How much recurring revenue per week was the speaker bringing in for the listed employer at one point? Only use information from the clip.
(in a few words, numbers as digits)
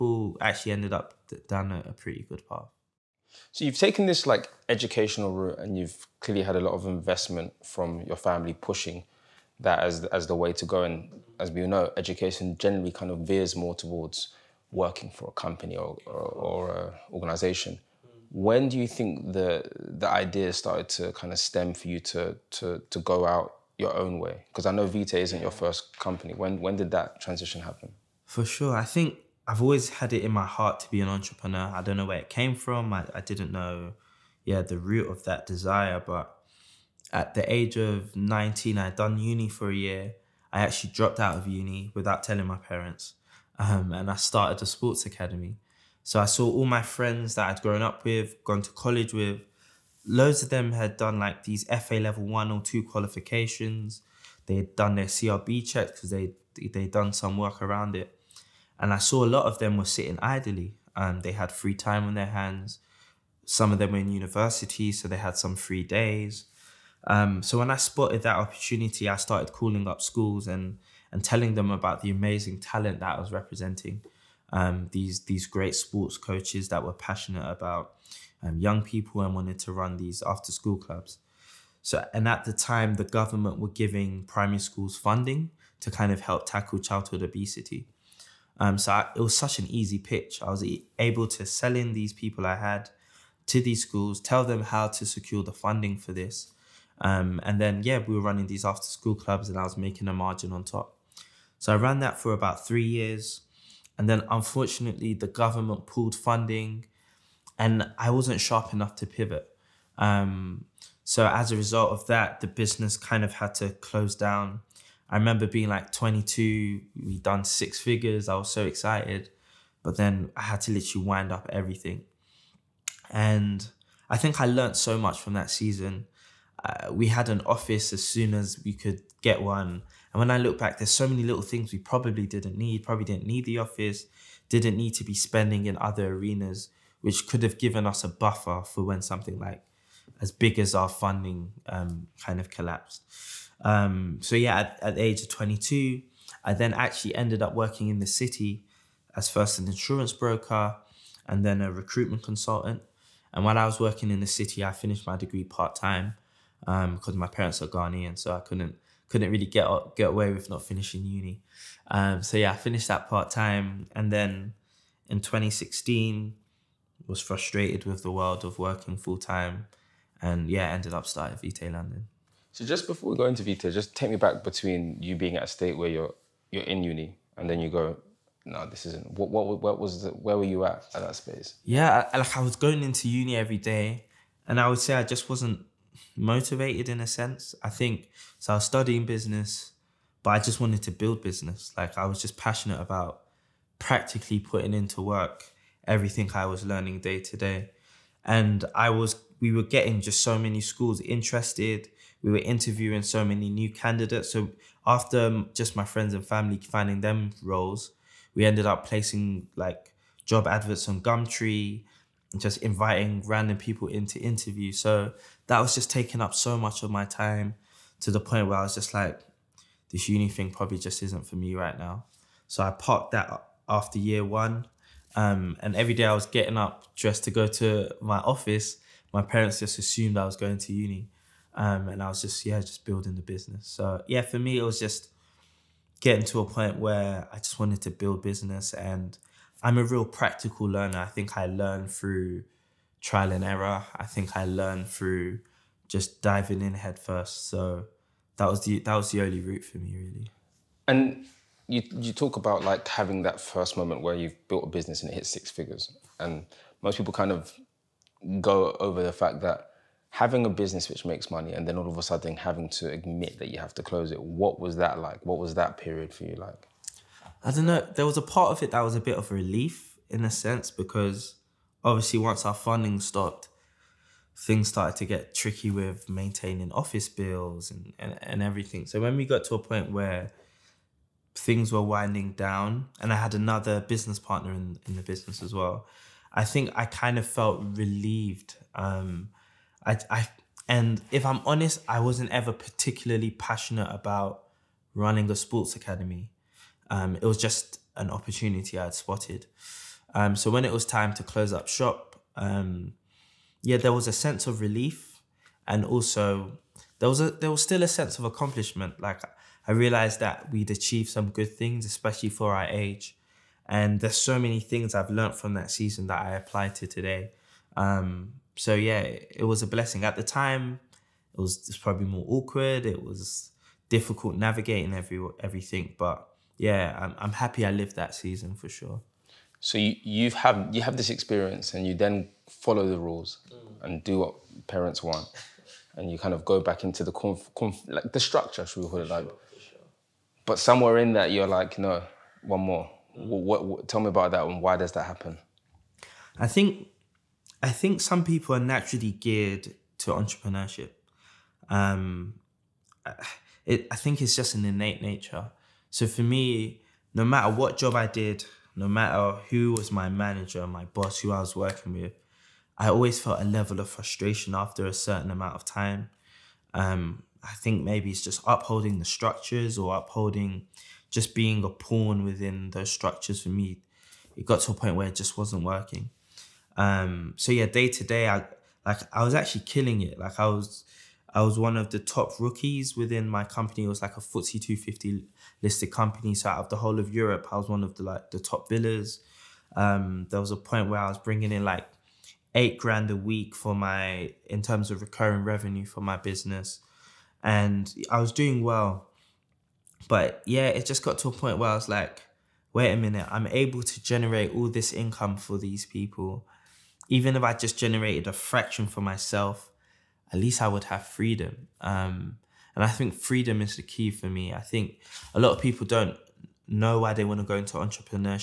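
8 grand.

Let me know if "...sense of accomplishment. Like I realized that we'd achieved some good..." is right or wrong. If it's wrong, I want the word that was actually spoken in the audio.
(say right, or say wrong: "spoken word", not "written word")
right.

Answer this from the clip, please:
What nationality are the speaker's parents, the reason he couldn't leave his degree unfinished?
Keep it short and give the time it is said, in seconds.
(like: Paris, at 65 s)
Ghanaian, at 157 s.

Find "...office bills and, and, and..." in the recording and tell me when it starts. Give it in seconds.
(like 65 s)
276 s.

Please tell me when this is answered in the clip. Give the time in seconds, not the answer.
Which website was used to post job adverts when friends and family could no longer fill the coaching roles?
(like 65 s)
211 s.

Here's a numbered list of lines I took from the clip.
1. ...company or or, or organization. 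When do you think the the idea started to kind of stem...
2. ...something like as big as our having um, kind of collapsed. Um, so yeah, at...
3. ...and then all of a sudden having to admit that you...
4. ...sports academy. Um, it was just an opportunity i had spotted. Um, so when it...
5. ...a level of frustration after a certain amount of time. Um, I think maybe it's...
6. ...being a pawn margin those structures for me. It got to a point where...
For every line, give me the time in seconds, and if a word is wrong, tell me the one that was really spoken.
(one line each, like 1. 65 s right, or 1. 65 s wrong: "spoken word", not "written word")
1. 15 s right
2. 139 s wrong: "funding", not "having"
3. 261 s right
4. 295 s right
5. 363 s right
6. 371 s wrong: "within", not "margin".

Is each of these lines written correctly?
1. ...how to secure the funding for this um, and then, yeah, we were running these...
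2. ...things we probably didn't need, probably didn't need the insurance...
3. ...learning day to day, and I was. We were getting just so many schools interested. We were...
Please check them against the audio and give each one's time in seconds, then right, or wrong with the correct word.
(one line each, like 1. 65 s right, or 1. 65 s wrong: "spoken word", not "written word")
1. 94 s right
2. 131 s wrong: "office", not "insurance"
3. 196 s right.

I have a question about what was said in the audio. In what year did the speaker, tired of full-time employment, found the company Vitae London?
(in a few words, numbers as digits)
2016.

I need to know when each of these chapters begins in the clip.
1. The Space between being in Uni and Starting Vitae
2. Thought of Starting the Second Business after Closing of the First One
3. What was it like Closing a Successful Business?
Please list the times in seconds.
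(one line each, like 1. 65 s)
1. 171 s
2. 329 s
3. 250 s.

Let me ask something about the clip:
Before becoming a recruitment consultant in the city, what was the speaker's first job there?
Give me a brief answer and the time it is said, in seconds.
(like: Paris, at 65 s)
insurance broker, at 149 s.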